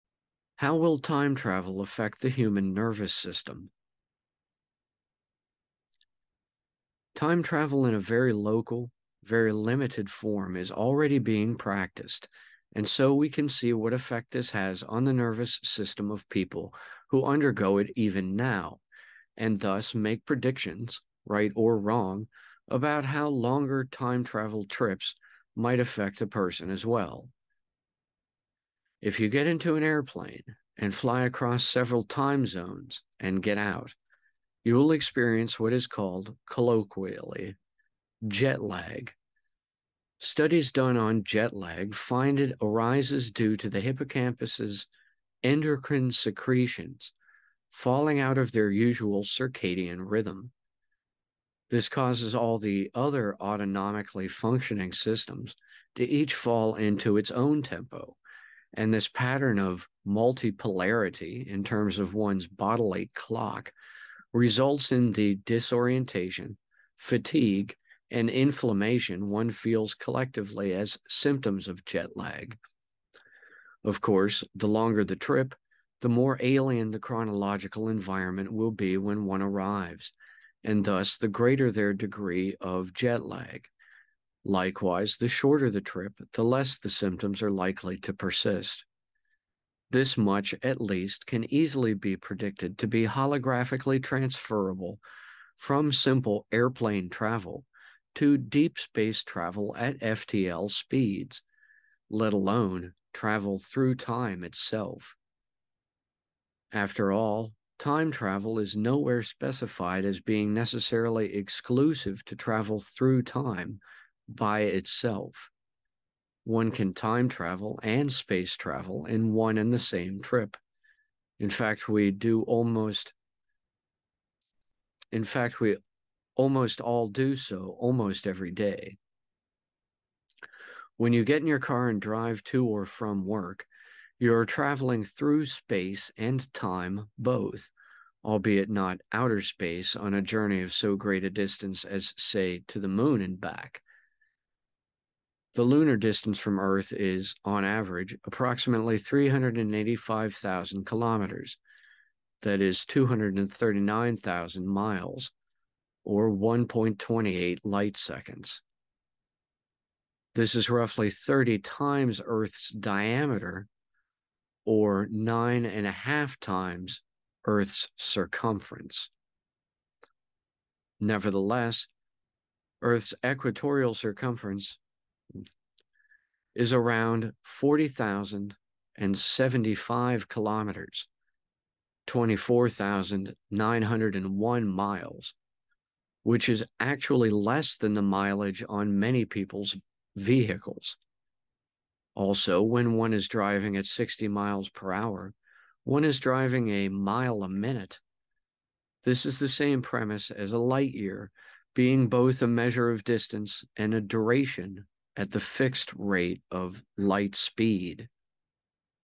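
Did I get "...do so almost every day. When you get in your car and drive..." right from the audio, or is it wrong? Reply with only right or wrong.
right.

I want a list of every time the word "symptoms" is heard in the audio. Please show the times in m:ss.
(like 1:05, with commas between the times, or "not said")
1:11, 1:26.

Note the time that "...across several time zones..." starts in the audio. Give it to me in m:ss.
0:31.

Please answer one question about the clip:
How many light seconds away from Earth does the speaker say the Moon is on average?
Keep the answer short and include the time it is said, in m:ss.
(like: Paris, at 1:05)
1.28, at 2:36.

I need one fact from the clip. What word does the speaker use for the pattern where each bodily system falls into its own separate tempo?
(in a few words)
multipolarity.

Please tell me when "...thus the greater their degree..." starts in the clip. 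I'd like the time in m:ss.
1:20.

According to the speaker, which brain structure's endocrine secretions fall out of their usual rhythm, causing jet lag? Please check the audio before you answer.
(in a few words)
hippocampus.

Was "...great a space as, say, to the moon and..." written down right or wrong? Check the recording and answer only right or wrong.
wrong.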